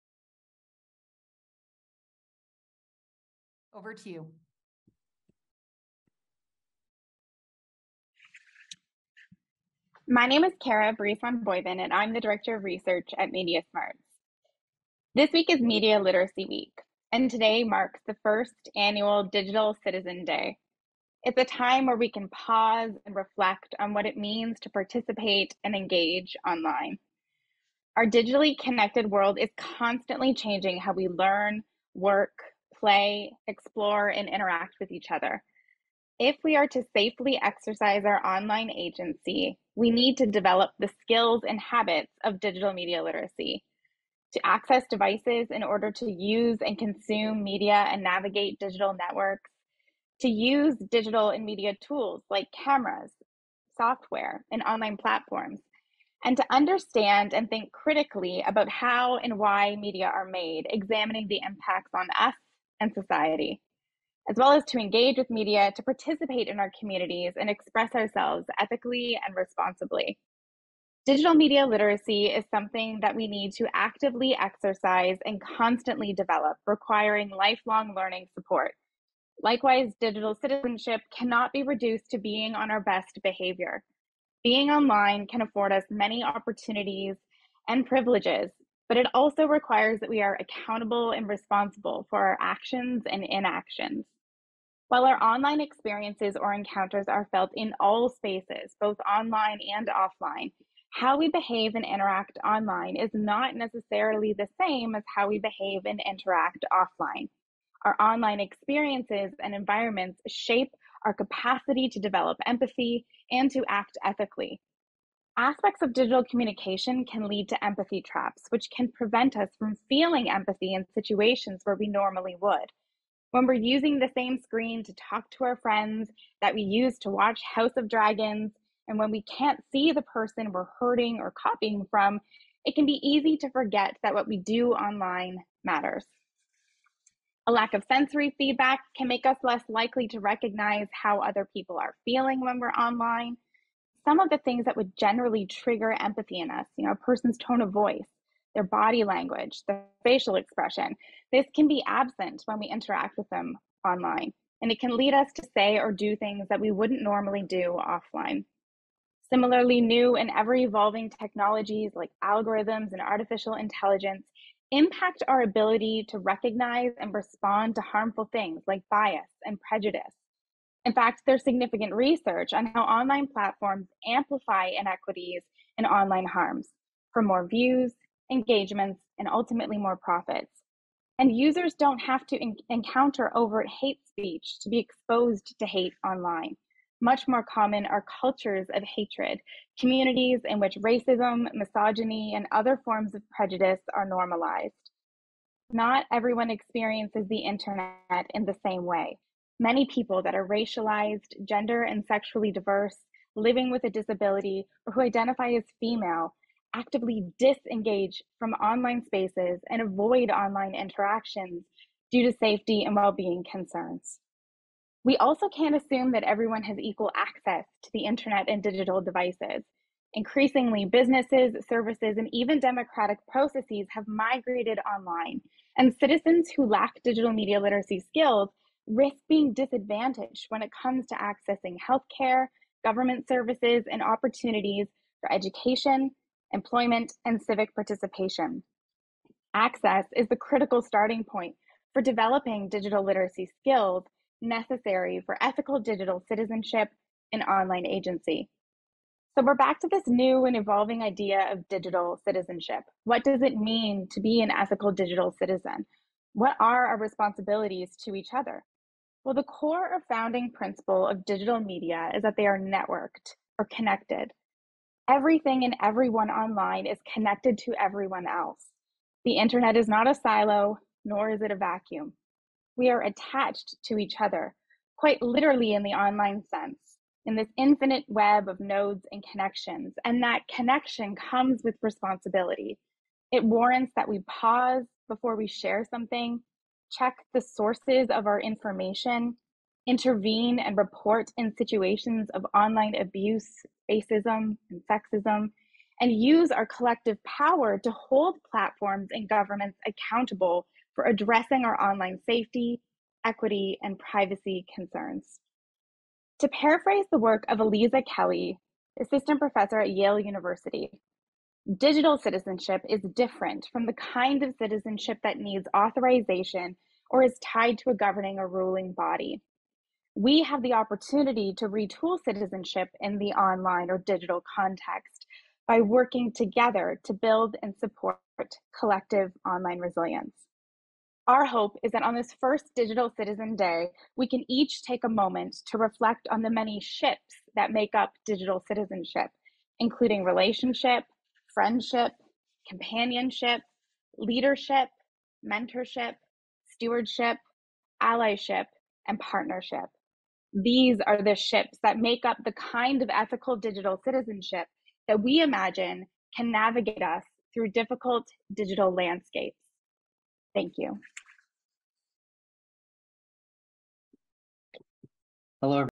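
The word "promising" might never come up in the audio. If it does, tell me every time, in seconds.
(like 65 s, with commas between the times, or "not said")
not said.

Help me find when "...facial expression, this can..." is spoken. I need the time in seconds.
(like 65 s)
150 s.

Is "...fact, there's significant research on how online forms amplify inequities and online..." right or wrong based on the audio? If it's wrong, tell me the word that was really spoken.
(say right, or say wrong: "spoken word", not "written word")
wrong: "platforms", not "forms".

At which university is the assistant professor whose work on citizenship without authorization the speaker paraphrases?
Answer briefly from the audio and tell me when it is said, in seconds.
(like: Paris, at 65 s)
Yale University, at 309 s.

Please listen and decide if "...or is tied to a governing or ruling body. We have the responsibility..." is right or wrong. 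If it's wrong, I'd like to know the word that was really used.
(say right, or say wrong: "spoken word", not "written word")
wrong: "opportunity", not "responsibility".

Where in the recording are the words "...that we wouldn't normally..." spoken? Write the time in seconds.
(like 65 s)
156 s.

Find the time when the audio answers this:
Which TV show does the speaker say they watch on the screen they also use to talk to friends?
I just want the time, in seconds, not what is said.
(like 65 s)
127 s.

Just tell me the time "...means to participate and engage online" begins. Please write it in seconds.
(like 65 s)
24 s.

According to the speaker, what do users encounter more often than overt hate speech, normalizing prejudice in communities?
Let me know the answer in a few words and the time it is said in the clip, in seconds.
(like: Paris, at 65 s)
cultures of hatred, at 188 s.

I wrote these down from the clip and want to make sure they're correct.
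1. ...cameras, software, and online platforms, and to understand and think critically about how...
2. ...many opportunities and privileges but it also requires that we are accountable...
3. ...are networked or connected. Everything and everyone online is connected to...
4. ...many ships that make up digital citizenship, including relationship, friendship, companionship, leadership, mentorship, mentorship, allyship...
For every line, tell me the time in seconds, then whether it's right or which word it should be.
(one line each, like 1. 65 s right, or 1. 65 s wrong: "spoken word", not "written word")
1. 52 s right
2. 85 s right
3. 262 s right
4. 336 s wrong: "stewardship", not "mentorship".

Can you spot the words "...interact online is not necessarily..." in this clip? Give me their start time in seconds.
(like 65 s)
101 s.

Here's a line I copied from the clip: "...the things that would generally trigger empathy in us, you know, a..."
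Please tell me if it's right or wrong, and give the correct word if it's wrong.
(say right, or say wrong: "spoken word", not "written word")
right.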